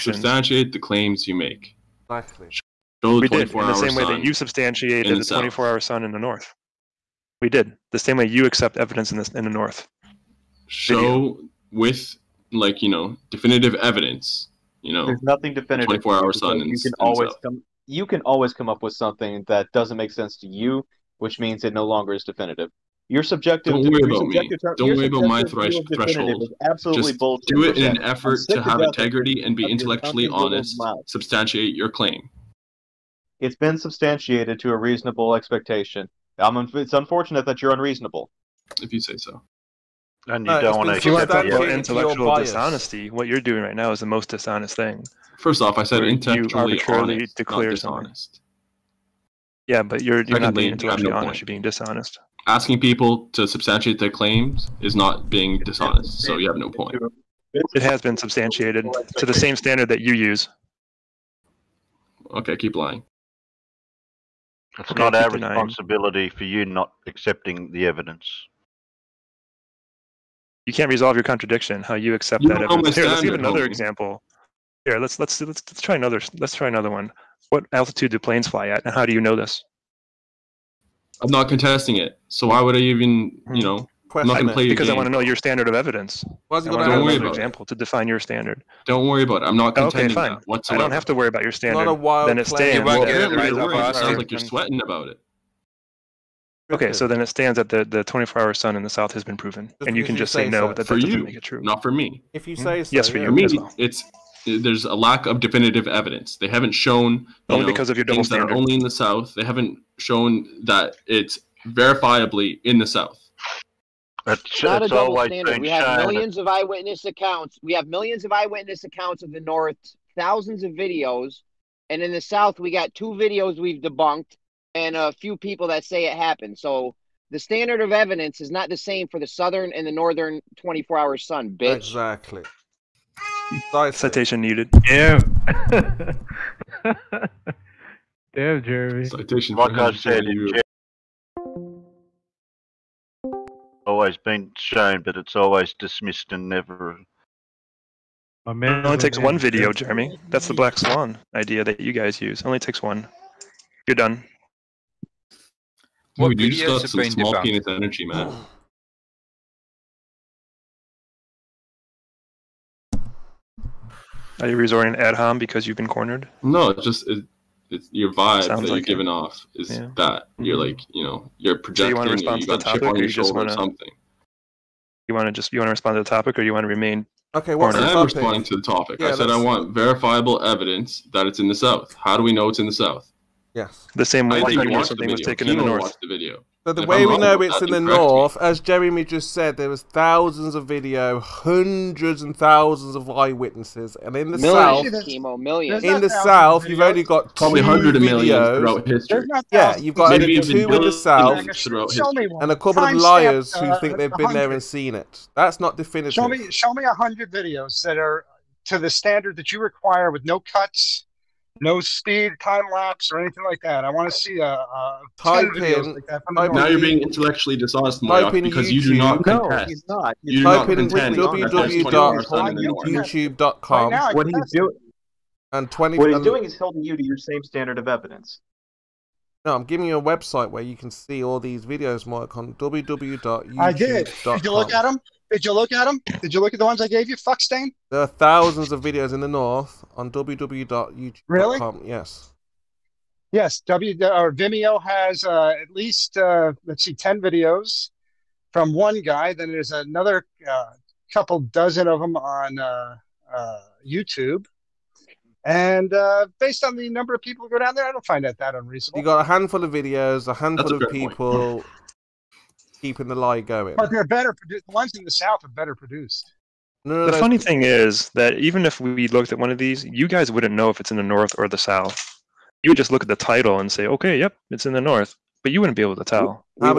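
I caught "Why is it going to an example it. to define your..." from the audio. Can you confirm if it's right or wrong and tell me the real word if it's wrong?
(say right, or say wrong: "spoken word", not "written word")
right.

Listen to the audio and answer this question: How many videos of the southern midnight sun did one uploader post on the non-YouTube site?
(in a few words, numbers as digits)
10.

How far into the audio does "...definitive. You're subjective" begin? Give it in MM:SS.
00:22.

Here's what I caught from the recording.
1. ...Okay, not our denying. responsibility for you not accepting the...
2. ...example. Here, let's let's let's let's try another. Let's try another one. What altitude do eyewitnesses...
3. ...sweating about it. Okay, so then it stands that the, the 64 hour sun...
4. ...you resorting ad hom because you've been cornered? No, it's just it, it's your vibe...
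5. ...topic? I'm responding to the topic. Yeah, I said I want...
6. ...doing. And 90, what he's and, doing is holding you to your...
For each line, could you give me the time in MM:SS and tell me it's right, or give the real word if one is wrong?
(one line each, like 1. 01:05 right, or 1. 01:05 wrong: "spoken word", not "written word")
1. 01:04 right
2. 01:13 wrong: "planes", not "eyewitnesses"
3. 01:34 wrong: "24", not "64"
4. 02:44 right
5. 02:57 right
6. 03:44 wrong: "20", not "90".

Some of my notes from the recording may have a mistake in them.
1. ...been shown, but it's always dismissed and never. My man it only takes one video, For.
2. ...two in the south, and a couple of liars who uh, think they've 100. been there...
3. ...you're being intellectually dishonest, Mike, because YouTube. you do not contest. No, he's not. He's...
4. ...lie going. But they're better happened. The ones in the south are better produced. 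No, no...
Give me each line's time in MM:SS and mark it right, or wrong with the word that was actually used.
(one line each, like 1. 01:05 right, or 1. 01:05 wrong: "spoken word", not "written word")
1. 02:24 wrong: "Jeremy", not "For"
2. 03:20 right
3. 03:36 right
4. 04:23 wrong: "produced", not "happened".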